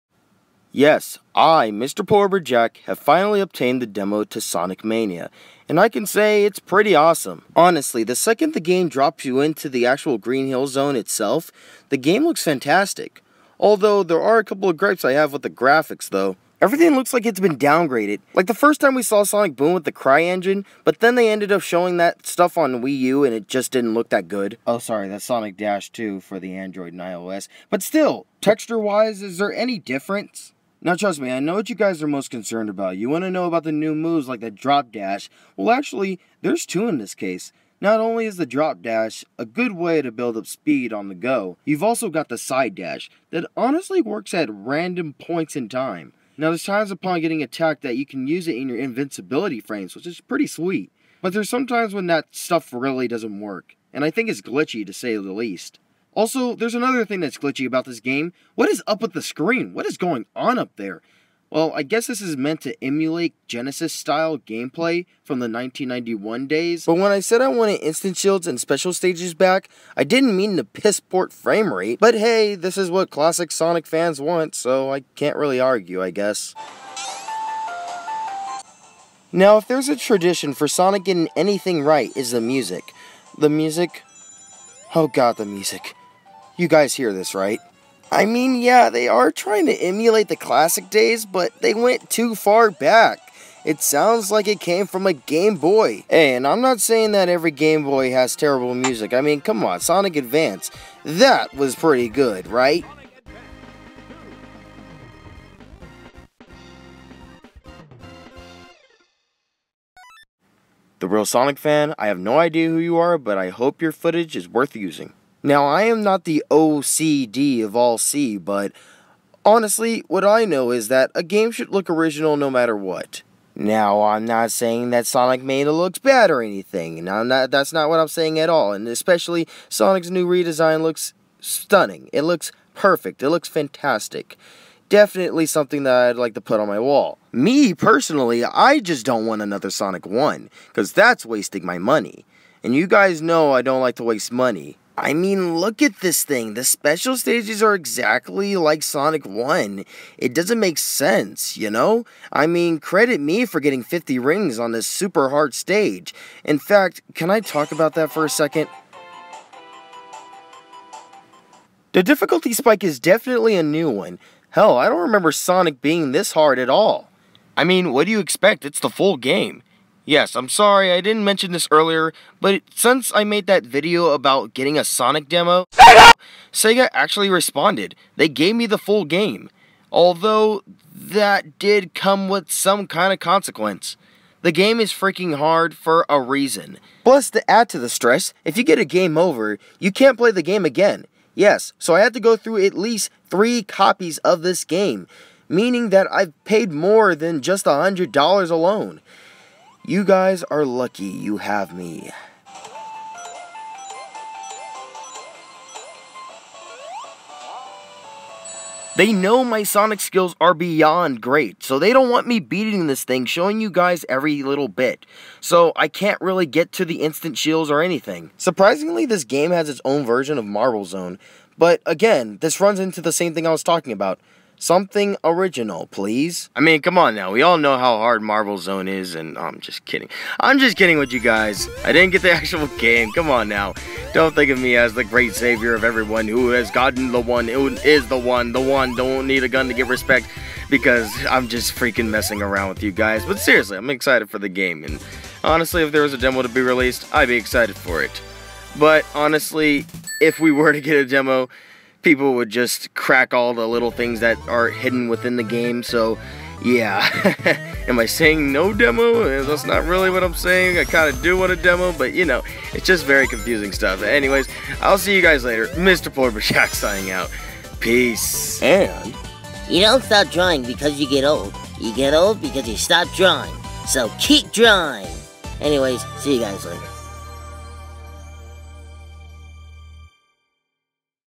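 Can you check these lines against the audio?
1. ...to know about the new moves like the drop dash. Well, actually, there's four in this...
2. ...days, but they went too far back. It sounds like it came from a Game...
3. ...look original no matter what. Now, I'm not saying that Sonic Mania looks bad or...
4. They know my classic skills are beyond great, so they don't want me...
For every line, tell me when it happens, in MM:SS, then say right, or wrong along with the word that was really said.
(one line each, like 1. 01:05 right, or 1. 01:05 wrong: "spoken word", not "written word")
1. 00:33 wrong: "two", not "four"
2. 01:30 right
3. 02:01 right
4. 03:28 wrong: "sonic", not "classic".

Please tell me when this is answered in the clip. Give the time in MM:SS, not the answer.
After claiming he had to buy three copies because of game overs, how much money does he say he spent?
03:16.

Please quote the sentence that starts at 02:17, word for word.
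Me, personally, I just don't want another Sonic 1, because that's wasting my money.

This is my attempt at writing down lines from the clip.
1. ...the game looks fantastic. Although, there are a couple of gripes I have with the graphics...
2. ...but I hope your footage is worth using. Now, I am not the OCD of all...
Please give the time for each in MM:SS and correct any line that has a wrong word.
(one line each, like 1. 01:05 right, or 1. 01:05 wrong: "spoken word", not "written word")
1. 00:11 right
2. 01:53 right.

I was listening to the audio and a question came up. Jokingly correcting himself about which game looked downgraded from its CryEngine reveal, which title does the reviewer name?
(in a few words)
Sonic Dash 2.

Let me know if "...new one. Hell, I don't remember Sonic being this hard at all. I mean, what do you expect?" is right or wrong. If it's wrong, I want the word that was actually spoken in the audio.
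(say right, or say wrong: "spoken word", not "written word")
right.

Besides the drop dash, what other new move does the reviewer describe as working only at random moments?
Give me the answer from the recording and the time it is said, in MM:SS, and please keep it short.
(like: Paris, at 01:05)
side dash, at 00:42.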